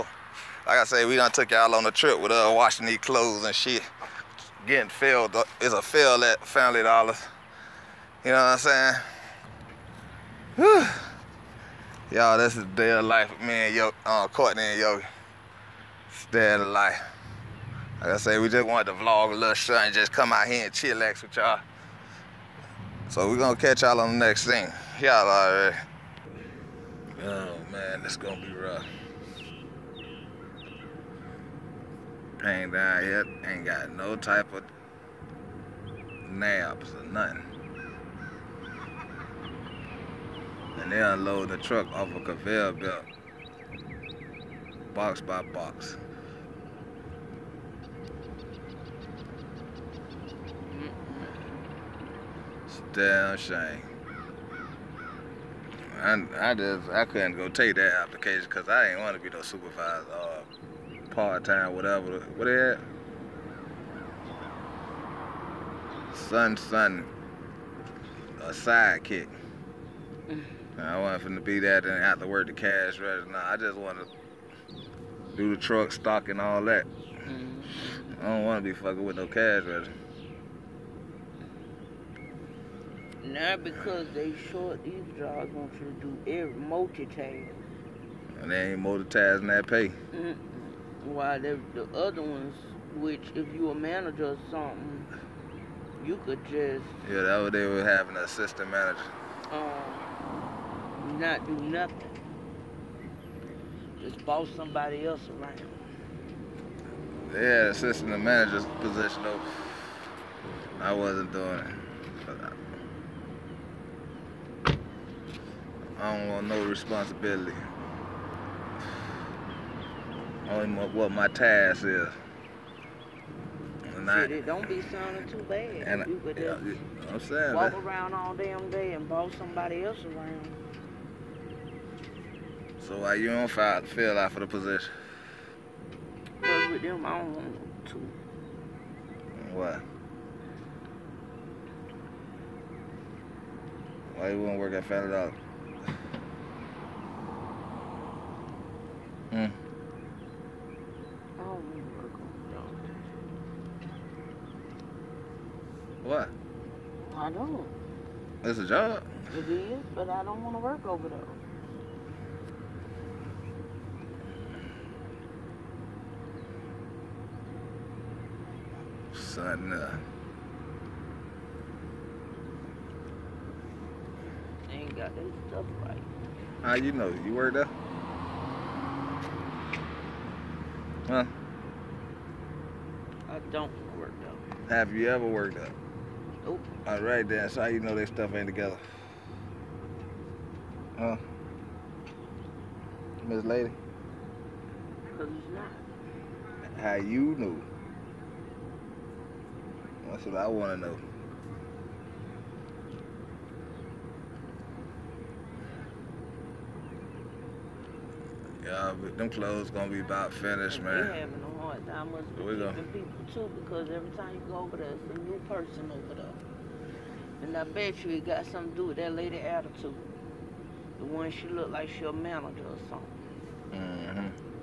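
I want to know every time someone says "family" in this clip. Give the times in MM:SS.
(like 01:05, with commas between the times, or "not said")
00:06, 02:24.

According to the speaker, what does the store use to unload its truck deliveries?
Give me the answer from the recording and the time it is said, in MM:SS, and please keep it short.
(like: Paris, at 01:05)
Conveyor belt, at 00:42.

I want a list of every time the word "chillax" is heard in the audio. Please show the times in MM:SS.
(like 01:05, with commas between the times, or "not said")
00:20.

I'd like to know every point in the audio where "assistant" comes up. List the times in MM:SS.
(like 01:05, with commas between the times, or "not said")
01:38, 01:47.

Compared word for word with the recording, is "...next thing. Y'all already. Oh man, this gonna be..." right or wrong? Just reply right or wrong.
right.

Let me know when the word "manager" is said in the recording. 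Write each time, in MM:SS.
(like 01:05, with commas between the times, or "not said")
01:33, 01:38, 01:48, 03:42.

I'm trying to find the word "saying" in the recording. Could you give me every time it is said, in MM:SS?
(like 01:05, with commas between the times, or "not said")
00:10, 02:07.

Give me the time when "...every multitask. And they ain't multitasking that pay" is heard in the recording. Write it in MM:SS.
01:26.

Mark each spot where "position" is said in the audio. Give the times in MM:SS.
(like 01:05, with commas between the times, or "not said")
01:48, 02:14.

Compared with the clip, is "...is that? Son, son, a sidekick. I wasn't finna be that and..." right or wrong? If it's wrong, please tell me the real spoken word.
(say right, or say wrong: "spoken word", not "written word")
right.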